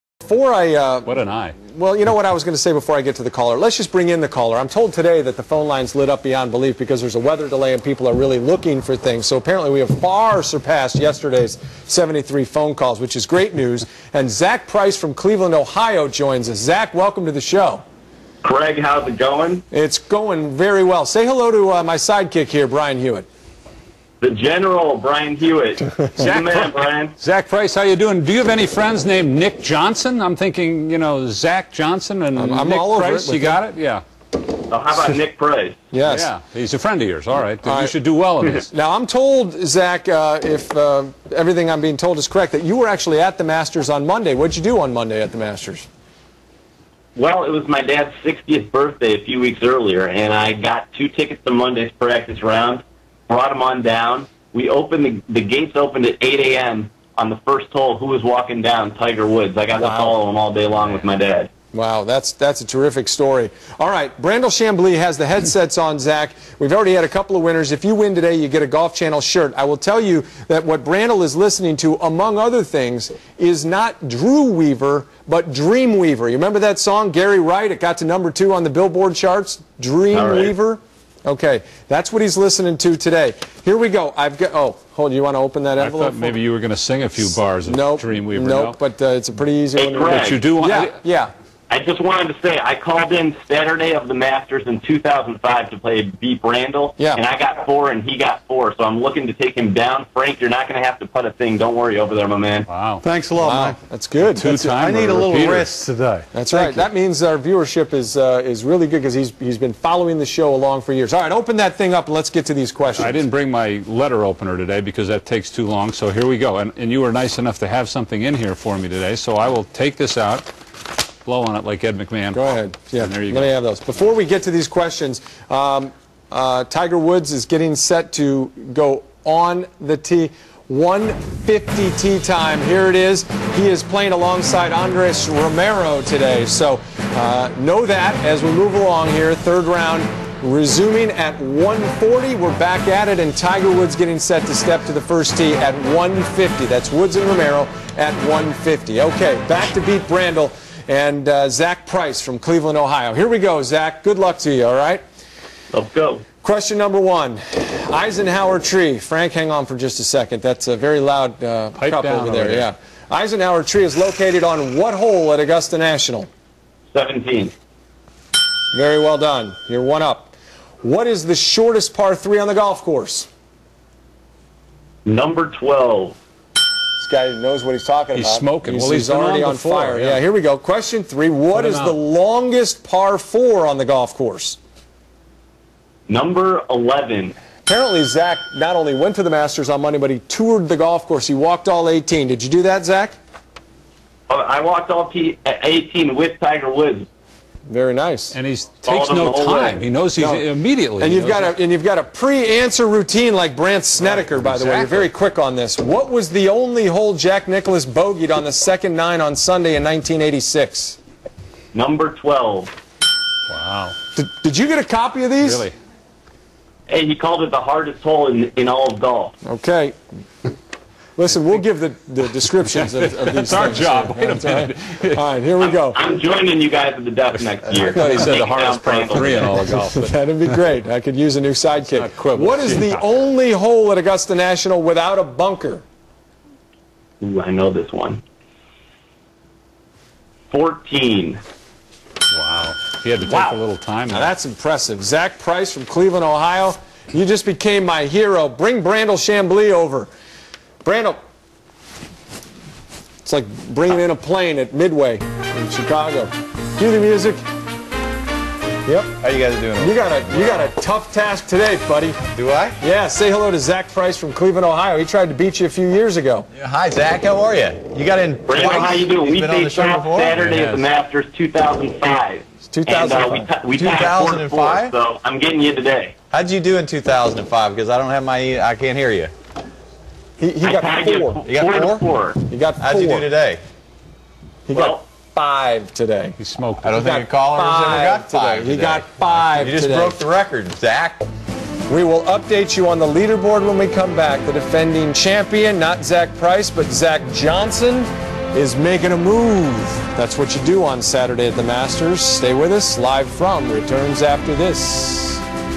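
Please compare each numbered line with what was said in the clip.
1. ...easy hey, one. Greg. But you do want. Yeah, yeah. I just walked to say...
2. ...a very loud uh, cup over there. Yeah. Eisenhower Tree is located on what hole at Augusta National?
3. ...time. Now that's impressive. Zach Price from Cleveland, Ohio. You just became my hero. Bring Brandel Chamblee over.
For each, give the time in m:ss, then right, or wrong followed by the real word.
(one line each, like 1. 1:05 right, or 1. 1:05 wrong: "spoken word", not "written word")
1. 1:29 wrong: "wanted", not "walked"
2. 2:40 right
3. 4:03 right.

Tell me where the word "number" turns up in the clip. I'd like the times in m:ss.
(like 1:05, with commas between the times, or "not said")
1:18, 2:36, 2:55, 3:06, 3:31.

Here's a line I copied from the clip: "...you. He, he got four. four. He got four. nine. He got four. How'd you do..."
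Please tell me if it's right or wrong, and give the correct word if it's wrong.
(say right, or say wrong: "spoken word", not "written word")
wrong: "four", not "nine".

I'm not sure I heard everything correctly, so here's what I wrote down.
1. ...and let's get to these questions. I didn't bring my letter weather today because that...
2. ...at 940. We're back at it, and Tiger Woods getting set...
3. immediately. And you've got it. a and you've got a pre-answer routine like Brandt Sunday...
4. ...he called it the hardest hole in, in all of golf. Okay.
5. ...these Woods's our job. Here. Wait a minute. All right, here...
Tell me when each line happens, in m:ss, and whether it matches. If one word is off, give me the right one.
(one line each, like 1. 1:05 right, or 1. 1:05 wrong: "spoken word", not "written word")
1. 1:52 wrong: "opener", not "weather"
2. 2:21 wrong: "140", not "940"
3. 3:20 wrong: "Snedeker", not "Sunday"
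4. 3:37 right
5. 3:43 wrong: "That", not "Woods".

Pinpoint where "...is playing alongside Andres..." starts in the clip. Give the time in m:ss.
2:13.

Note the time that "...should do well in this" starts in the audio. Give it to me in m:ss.
0:37.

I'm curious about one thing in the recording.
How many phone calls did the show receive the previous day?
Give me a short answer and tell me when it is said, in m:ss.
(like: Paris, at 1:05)
73, at 0:11.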